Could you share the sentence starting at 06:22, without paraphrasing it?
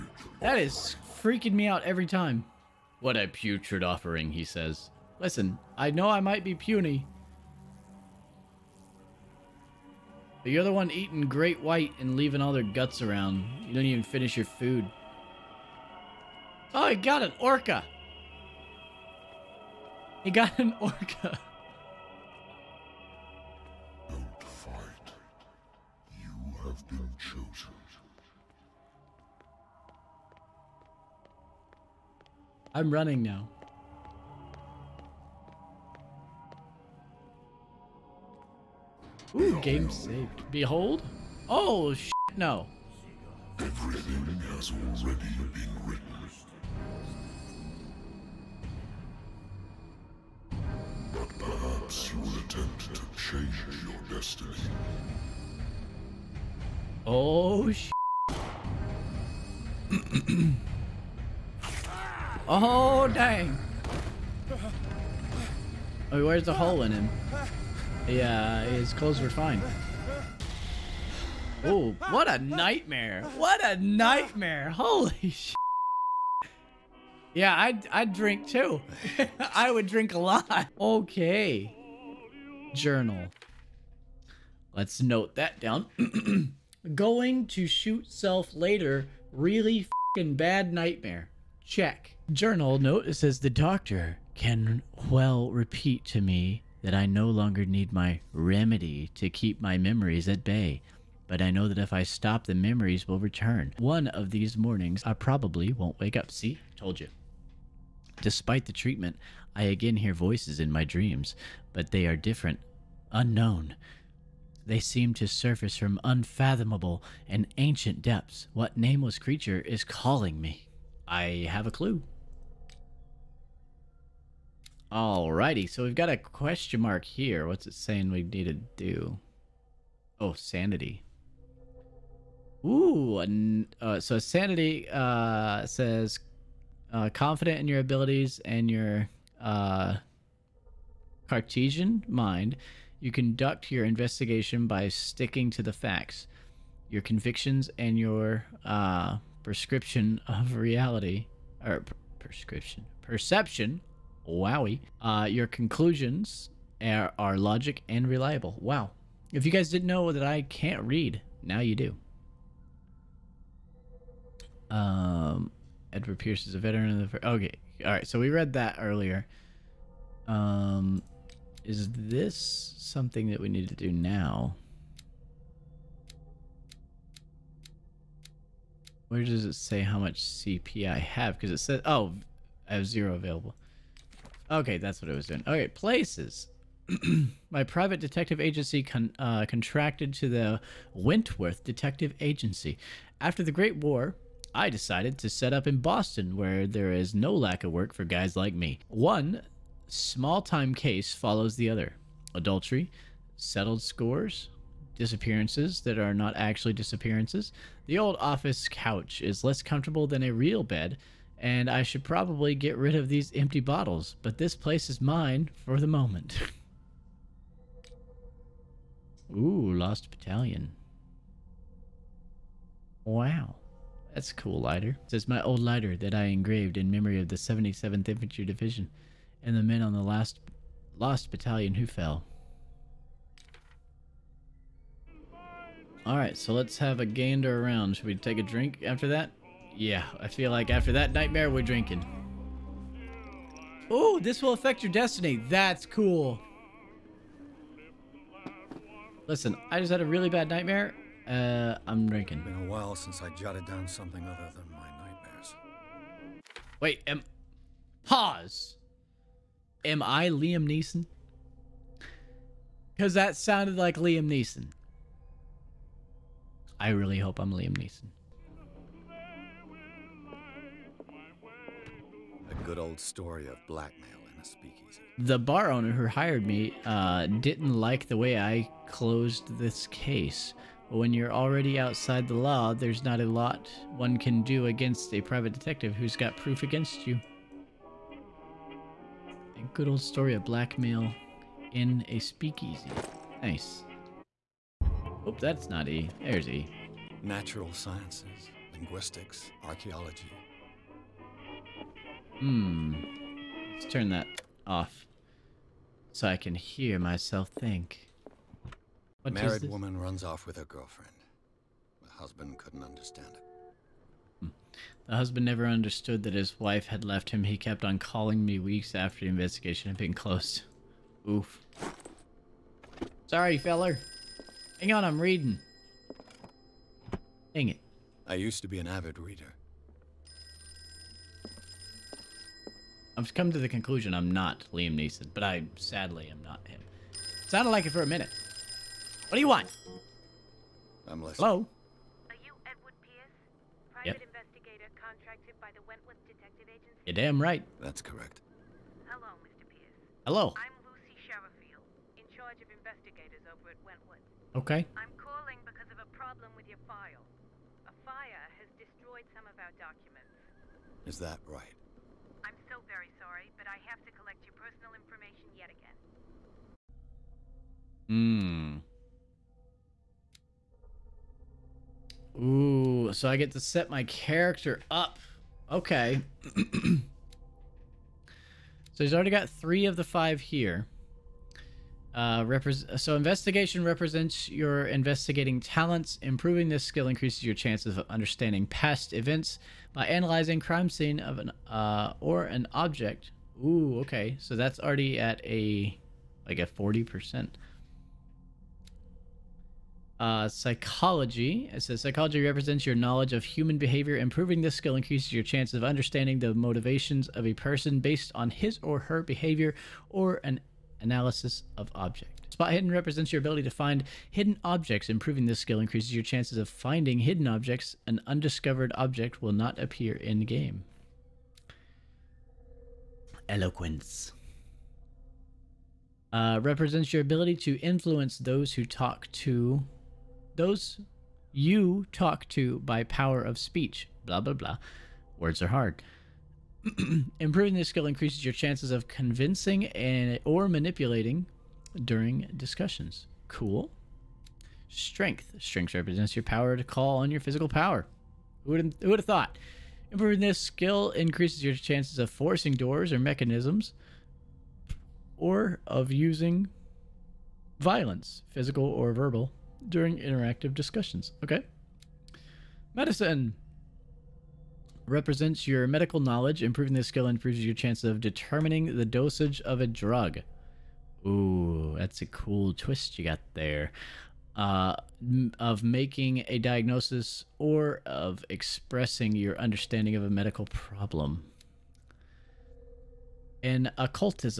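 Uh, so investigation represents your investigating talents.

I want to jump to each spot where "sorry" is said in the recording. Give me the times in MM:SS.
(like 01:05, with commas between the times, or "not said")
05:23, 06:03.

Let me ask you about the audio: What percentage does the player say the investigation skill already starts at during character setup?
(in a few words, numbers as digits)
40%.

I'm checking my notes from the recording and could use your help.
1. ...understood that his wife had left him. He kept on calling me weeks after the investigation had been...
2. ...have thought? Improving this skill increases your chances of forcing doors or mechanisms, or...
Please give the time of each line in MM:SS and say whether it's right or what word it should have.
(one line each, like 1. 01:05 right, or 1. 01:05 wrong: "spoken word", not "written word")
1. 05:15 right
2. 07:29 right.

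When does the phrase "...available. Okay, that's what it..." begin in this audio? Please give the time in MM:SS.
03:03.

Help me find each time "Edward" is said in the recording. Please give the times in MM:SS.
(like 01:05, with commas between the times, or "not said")
02:45, 05:42.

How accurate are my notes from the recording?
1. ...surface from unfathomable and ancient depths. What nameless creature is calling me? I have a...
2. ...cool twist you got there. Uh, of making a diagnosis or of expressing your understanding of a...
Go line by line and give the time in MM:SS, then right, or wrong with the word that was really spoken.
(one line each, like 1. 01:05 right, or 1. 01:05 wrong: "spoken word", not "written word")
1. 01:55 right
2. 07:52 right.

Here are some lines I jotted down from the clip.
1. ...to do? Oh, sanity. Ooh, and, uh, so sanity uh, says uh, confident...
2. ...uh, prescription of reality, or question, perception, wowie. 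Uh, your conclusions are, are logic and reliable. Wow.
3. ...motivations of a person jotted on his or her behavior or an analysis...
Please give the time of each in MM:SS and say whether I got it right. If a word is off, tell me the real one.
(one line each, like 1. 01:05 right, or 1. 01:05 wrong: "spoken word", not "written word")
1. 02:08 right
2. 02:28 wrong: "prescription", not "question"
3. 06:46 wrong: "based", not "jotted".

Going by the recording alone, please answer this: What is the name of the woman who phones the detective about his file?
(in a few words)
Lucy Sherifield.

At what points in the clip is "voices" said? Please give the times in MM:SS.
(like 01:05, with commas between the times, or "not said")
01:50.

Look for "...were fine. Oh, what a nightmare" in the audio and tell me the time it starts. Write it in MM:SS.
01:09.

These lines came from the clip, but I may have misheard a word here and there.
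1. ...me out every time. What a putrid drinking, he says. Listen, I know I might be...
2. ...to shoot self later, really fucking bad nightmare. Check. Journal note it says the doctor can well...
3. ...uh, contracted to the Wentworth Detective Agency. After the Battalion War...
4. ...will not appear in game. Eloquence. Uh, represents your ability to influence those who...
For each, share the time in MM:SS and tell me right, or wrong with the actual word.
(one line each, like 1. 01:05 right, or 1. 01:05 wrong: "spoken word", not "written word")
1. 00:01 wrong: "offering", not "drinking"
2. 01:27 right
3. 03:09 wrong: "Great", not "Battalion"
4. 06:59 right.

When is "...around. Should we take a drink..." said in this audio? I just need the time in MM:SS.
03:57.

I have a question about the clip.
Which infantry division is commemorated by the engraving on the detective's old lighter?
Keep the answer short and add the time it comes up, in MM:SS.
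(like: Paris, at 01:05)
77th Infantry Division, at 03:47.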